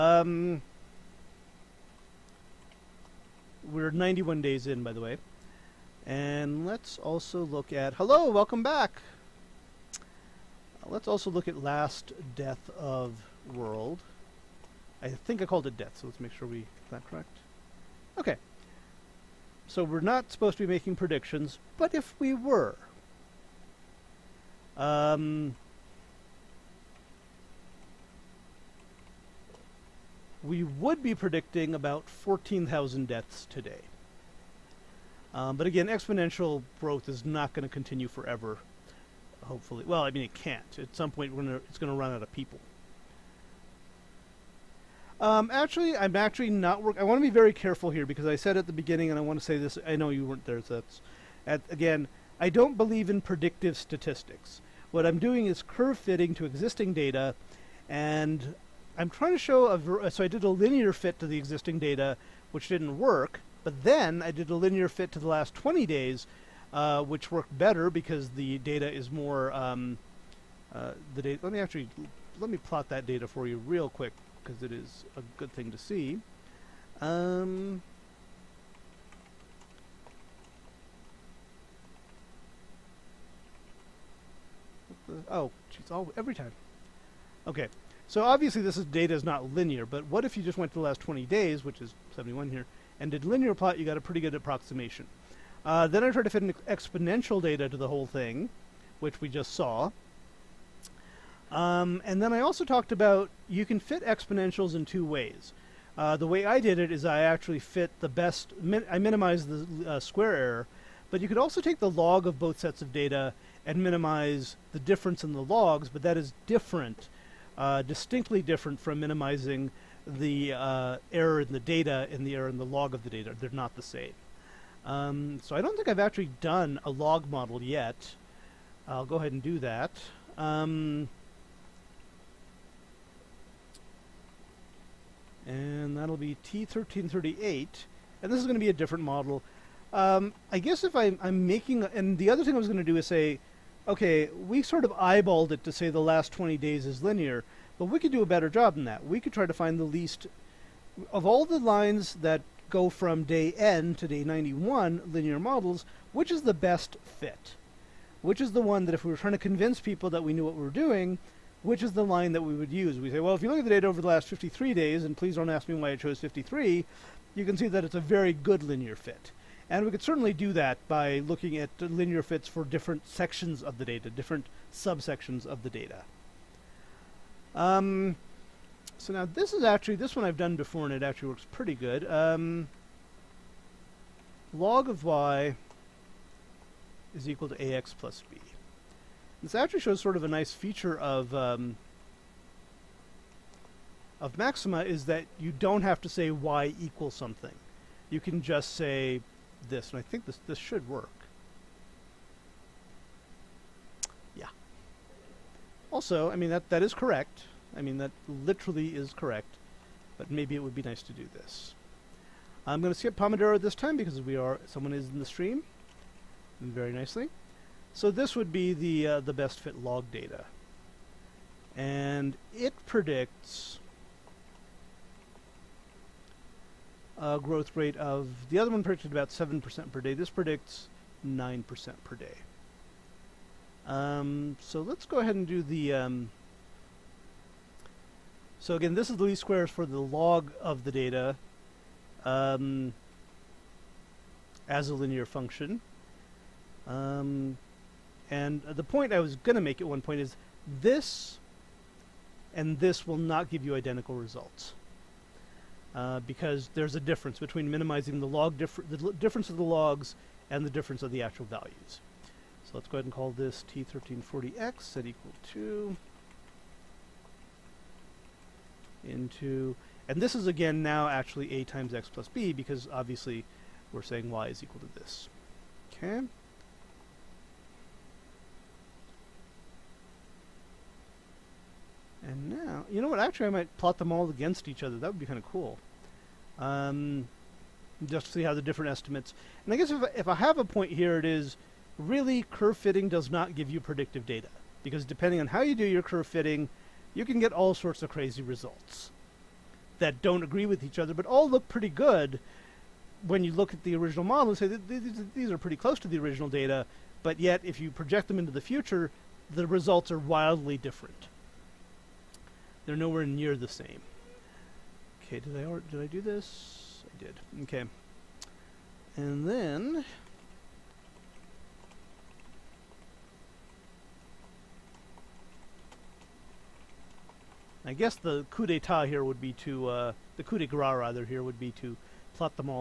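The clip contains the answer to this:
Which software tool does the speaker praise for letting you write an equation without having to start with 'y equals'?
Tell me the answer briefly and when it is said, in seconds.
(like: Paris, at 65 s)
Maxima, at 194 s.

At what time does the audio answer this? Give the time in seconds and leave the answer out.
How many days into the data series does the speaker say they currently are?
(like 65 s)
3 s.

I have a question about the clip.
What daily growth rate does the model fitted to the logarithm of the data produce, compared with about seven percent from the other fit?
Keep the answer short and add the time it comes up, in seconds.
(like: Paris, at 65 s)
9% per day, at 231 s.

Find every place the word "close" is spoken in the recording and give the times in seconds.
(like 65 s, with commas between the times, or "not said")
305 s.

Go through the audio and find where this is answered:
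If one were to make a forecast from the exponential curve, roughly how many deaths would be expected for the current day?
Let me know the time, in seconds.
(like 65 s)
32 s.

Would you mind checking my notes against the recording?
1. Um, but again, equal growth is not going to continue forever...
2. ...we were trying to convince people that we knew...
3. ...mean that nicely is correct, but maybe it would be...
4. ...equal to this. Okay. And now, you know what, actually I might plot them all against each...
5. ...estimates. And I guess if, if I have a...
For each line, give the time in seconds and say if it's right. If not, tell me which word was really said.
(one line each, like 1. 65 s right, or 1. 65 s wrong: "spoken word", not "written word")
1. 35 s wrong: "exponential", not "equal"
2. 159 s right
3. 207 s wrong: "literally", not "nicely"
4. 274 s right
5. 288 s right.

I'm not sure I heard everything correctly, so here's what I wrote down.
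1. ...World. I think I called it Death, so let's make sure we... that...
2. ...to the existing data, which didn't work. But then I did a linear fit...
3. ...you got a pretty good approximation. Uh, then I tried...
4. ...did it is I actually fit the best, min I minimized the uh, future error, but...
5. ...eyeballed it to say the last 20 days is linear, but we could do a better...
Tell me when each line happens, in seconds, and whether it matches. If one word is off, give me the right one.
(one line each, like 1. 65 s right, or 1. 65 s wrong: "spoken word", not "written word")
1. 13 s right
2. 61 s right
3. 93 s right
4. 106 s wrong: "square", not "future"
5. 144 s right.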